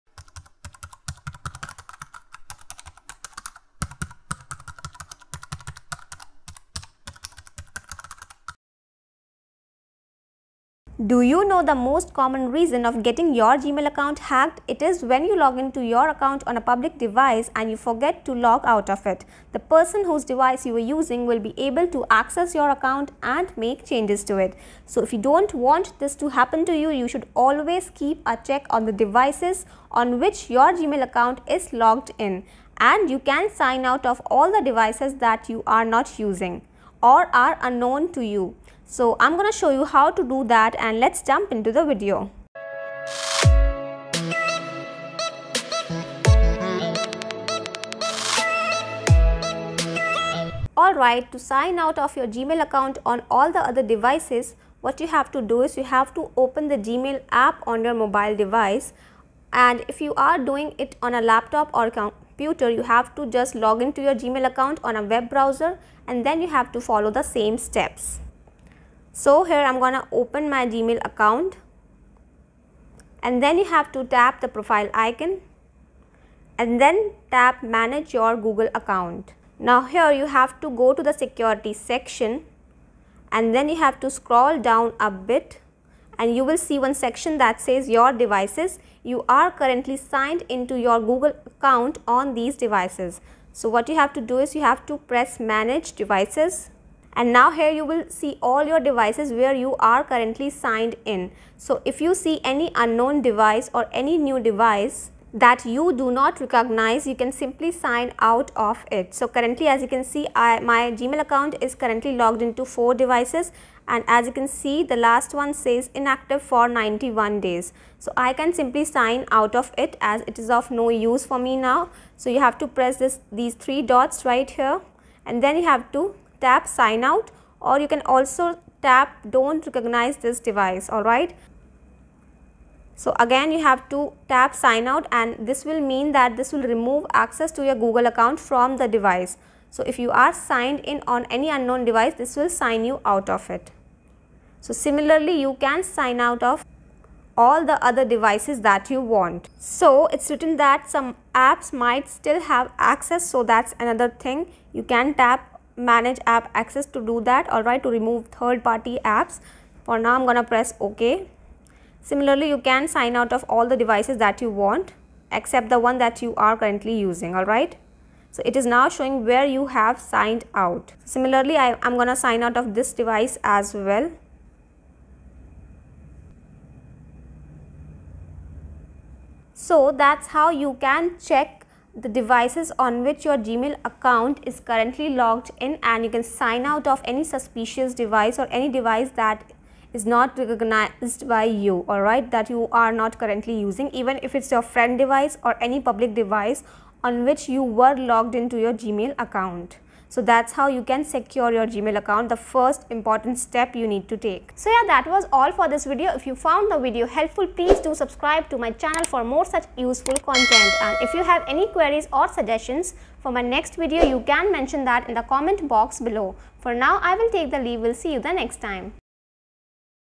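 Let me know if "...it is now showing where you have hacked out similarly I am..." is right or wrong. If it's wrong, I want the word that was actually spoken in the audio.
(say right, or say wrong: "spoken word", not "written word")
wrong: "signed", not "hacked".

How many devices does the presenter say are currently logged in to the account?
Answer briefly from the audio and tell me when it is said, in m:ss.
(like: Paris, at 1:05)
4, at 1:52.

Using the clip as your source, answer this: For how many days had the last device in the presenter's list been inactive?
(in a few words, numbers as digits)
91.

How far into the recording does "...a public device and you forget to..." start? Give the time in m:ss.
0:16.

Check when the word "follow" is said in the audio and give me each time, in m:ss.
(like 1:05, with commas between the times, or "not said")
1:06.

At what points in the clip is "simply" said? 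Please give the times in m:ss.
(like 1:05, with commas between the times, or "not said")
1:47, 1:58.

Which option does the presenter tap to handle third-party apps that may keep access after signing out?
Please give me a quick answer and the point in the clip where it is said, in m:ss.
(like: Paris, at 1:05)
Manage app access, at 2:35.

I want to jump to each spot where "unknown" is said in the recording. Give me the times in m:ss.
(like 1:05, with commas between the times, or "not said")
0:37, 1:42, 2:21.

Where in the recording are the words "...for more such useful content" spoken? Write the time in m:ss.
3:29.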